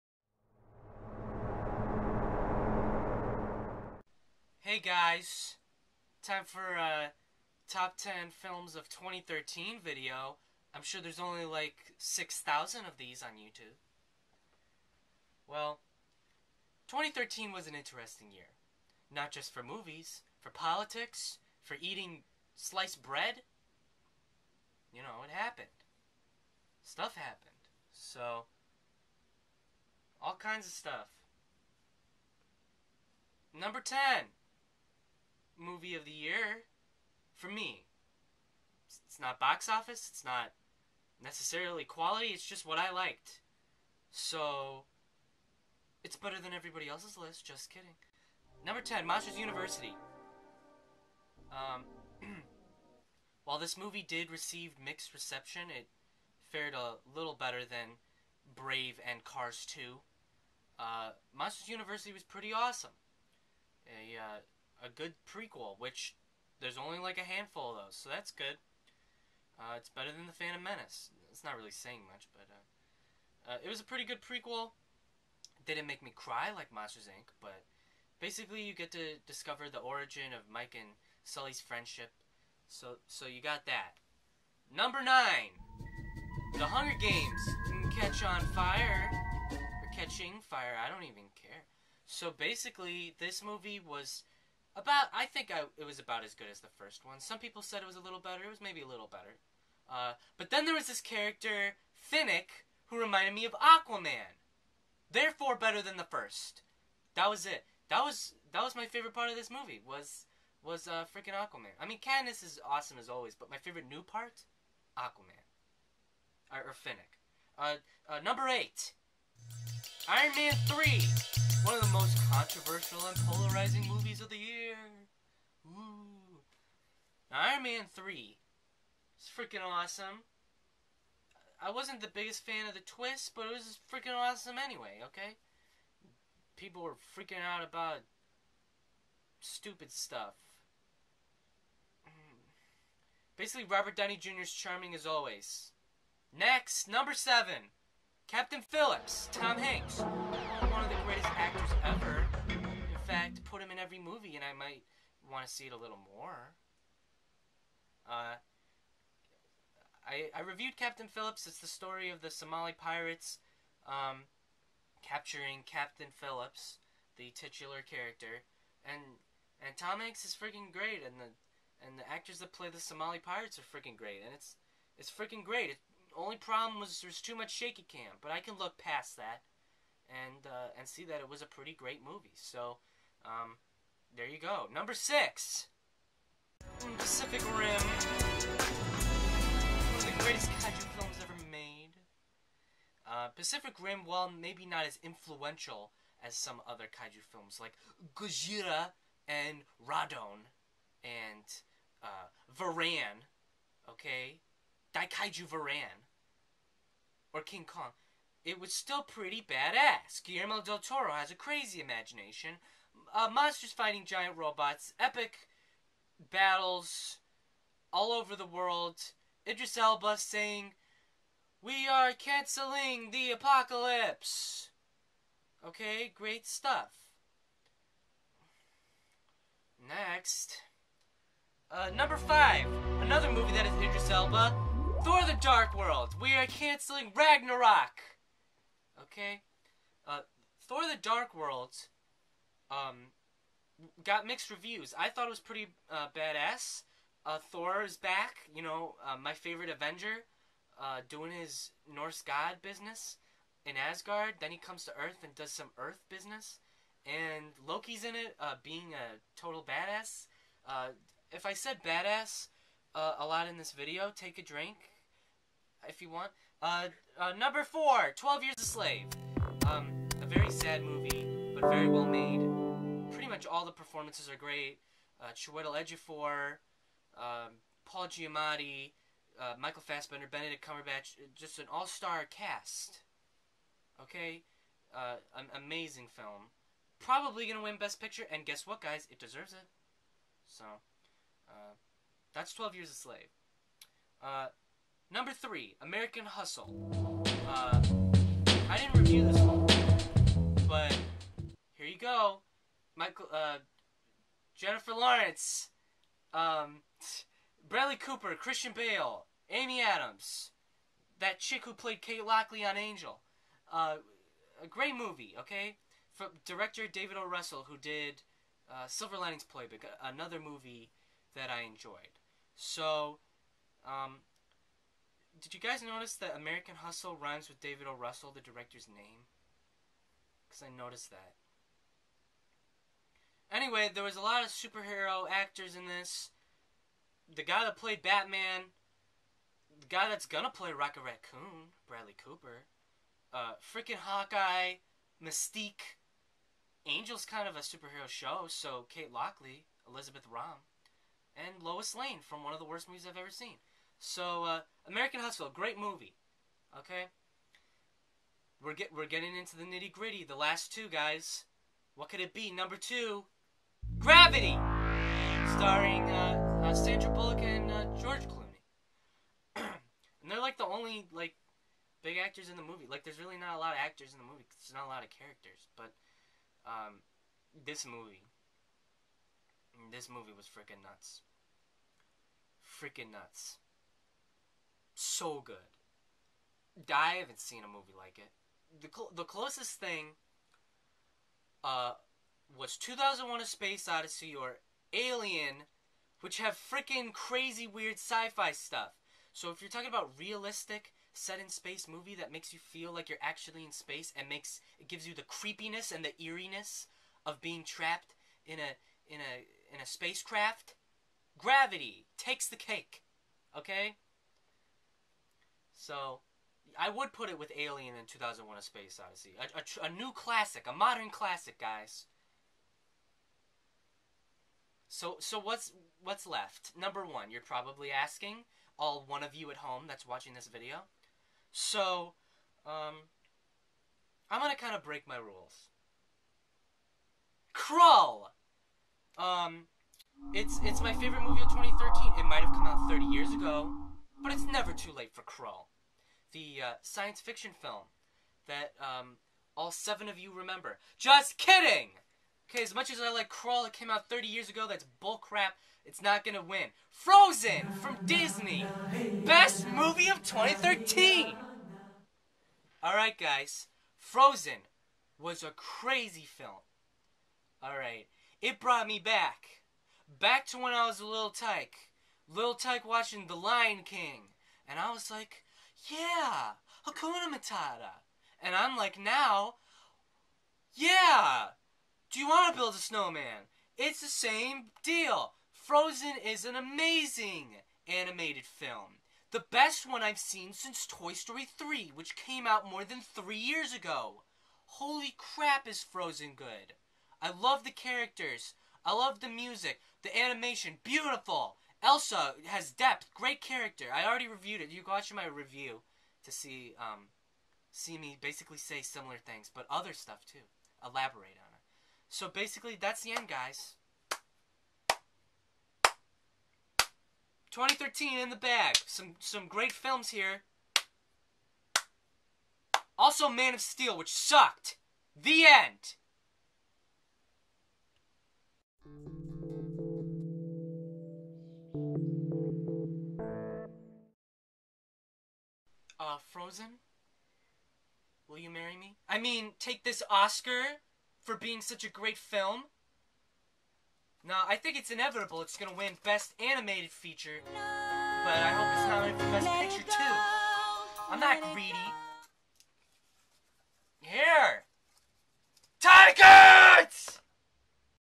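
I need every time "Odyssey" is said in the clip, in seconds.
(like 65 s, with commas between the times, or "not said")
393 s, 419 s.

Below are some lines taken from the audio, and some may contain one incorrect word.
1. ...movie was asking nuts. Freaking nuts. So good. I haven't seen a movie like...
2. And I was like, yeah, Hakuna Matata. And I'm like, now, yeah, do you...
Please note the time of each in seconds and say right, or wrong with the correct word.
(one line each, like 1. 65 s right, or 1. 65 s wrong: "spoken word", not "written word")
1. 380 s wrong: "freaking", not "asking"
2. 474 s right.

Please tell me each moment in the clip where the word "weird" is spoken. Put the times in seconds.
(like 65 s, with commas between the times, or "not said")
397 s.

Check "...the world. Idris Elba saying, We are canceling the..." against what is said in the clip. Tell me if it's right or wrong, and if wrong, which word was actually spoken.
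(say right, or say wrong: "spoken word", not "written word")
right.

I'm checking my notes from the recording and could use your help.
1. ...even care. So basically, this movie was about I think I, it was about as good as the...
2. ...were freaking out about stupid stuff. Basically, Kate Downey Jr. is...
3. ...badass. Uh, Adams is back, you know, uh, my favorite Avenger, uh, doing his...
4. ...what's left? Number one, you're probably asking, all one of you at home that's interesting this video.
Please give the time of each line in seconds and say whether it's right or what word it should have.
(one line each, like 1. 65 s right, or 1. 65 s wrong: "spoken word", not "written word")
1. 91 s right
2. 136 s wrong: "Robert", not "Kate"
3. 246 s wrong: "Thor", not "Adams"
4. 426 s wrong: "watching", not "interesting".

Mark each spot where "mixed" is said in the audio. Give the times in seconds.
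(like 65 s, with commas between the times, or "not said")
54 s, 244 s.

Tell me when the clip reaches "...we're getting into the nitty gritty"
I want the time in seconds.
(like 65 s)
358 s.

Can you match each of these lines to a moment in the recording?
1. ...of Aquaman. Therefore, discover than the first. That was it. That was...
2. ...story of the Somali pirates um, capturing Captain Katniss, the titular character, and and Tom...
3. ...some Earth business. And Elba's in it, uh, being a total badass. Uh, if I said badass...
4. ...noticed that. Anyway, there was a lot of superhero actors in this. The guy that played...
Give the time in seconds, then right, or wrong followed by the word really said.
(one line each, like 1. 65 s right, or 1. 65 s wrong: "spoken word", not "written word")
1. 103 s wrong: "better", not "discover"
2. 161 s wrong: "Phillips", not "Katniss"
3. 255 s wrong: "Loki", not "Elba"
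4. 330 s right.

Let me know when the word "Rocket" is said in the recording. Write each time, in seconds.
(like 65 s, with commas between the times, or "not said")
340 s.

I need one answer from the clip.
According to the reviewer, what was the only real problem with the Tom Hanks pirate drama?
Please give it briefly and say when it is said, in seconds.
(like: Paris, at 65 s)
too much shaky cam, at 177 s.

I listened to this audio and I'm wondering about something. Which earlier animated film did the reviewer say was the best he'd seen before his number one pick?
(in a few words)
Toy Story 3.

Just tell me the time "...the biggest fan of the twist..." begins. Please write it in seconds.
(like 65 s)
132 s.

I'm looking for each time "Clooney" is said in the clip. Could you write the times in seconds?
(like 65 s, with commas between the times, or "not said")
368 s.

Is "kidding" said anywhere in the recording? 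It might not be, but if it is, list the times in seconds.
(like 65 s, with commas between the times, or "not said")
47 s, 451 s.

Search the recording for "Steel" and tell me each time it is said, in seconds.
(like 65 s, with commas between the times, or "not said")
523 s.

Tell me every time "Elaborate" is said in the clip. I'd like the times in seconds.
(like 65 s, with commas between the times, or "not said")
510 s.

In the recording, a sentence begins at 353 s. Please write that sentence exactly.
So, uh, American Hustle, great movie.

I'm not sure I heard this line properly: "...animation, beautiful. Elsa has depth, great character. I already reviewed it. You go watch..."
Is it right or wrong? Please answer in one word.
right.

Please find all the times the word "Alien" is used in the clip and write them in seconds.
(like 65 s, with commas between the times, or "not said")
394 s, 417 s.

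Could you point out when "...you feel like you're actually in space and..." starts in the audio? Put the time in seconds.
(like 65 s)
402 s.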